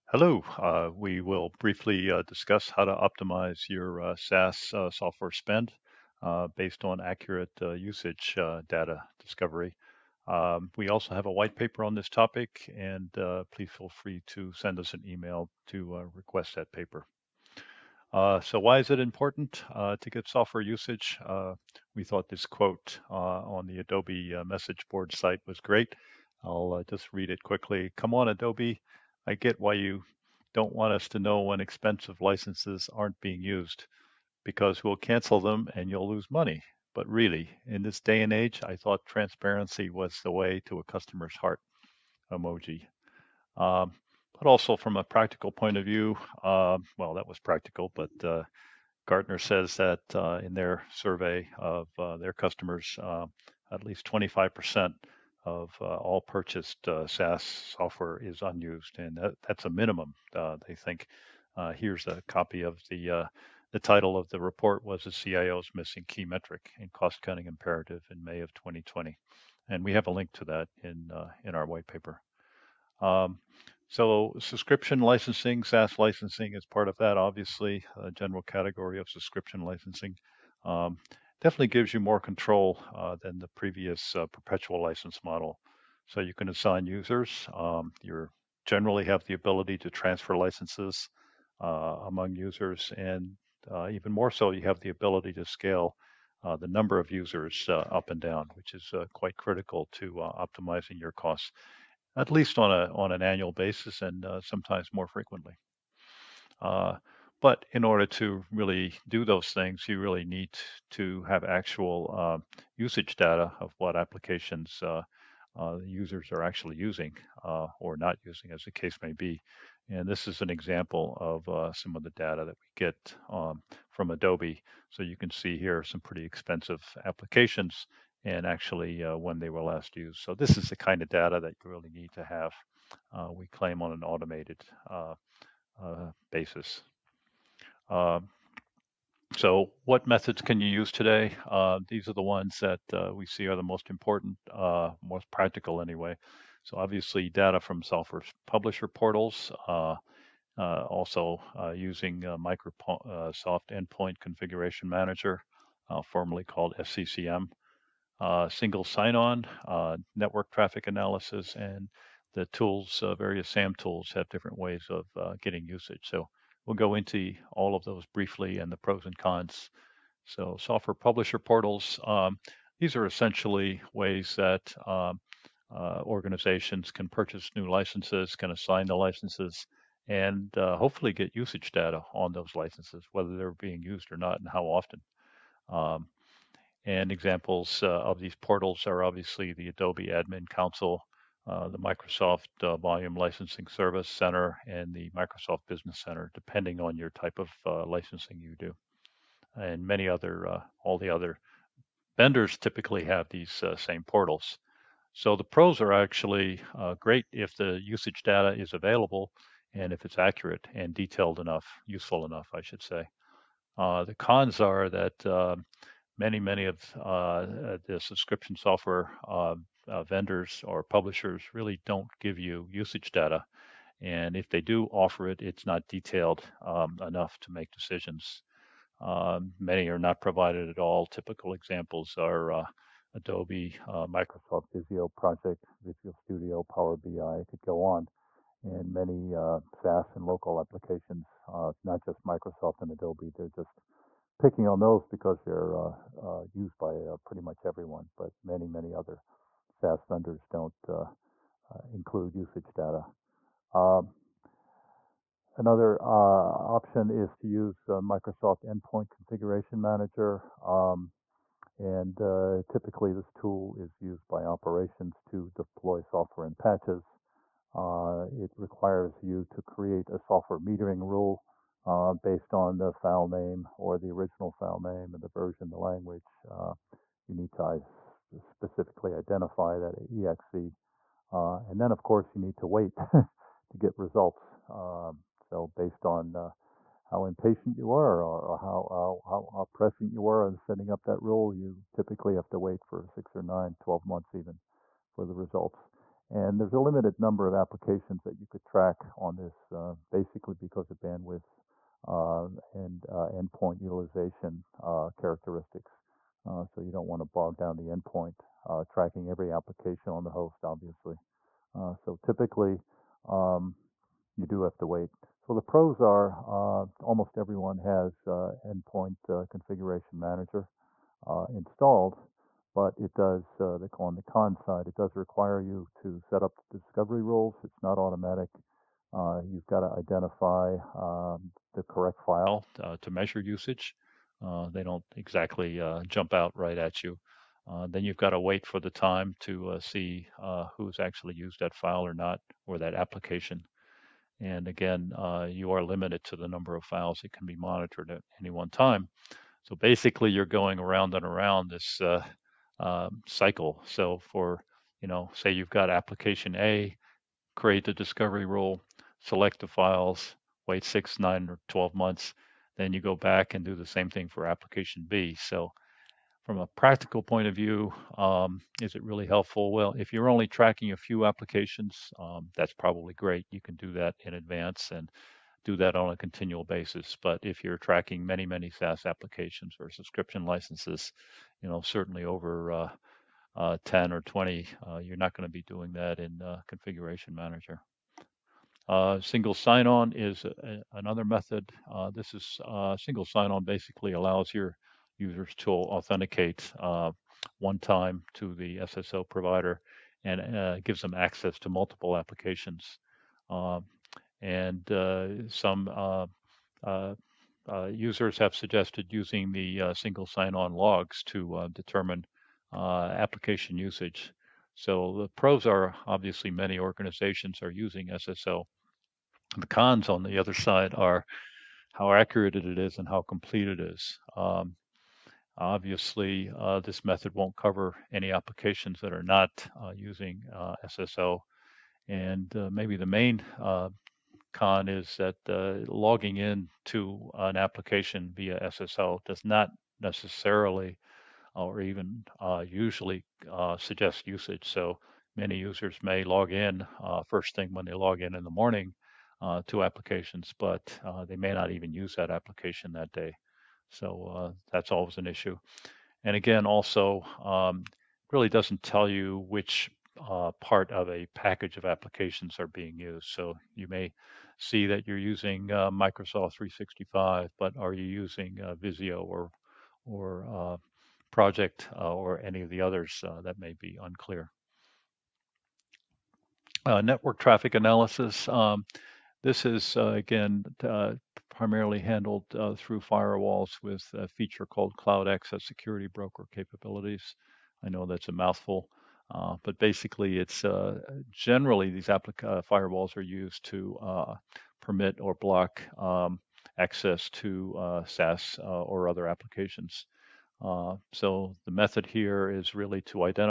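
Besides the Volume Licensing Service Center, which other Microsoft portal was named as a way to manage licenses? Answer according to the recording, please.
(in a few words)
Microsoft Business Center.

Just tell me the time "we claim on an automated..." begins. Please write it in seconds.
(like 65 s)
133 s.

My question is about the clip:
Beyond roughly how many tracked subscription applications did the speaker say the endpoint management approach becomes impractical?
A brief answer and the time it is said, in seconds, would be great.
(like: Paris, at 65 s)
10 or 20, at 383 s.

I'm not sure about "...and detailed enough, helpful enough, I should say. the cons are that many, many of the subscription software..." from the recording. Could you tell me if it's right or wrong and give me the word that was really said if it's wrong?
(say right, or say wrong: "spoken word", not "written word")
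wrong: "useful", not "helpful".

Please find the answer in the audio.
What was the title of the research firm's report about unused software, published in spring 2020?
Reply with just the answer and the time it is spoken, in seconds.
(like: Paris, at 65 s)
The CIO's Missing Key Metric, at 65 s.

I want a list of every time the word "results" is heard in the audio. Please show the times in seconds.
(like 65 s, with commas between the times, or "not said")
283 s, 295 s.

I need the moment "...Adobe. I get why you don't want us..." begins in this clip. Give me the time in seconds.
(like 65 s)
28 s.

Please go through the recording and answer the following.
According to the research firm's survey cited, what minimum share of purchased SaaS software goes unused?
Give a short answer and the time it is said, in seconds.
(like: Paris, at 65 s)
25%, at 54 s.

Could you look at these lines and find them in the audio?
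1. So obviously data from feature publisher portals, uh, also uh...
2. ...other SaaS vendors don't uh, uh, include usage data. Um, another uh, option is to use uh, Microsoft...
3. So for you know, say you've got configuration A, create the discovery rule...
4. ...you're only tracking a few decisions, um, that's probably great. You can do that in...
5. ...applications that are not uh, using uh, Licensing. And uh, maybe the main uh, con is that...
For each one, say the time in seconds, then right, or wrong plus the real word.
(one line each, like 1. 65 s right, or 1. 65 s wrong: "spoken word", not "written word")
1. 146 s wrong: "software", not "feature"
2. 248 s right
3. 353 s wrong: "application", not "configuration"
4. 370 s wrong: "applications", not "decisions"
5. 428 s wrong: "SSO", not "Licensing".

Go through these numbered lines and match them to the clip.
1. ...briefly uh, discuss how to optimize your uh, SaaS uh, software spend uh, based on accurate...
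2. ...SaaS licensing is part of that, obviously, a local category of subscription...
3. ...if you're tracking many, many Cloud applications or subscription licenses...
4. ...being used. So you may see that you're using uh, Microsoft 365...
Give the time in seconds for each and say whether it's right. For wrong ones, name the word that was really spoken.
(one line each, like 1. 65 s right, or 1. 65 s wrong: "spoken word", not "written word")
1. 1 s right
2. 75 s wrong: "general", not "local"
3. 377 s wrong: "SaaS", not "Cloud"
4. 462 s right.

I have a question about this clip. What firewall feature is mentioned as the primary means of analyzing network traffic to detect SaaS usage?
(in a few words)
Cloud Access Security Broker.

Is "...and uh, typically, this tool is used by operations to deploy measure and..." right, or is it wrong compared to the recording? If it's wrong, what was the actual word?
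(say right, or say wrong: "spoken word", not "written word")
wrong: "software", not "measure".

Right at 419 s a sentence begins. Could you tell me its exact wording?
The cons on the other side are how accurate it is and how complete it is.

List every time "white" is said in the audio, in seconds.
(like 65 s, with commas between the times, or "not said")
11 s, 71 s.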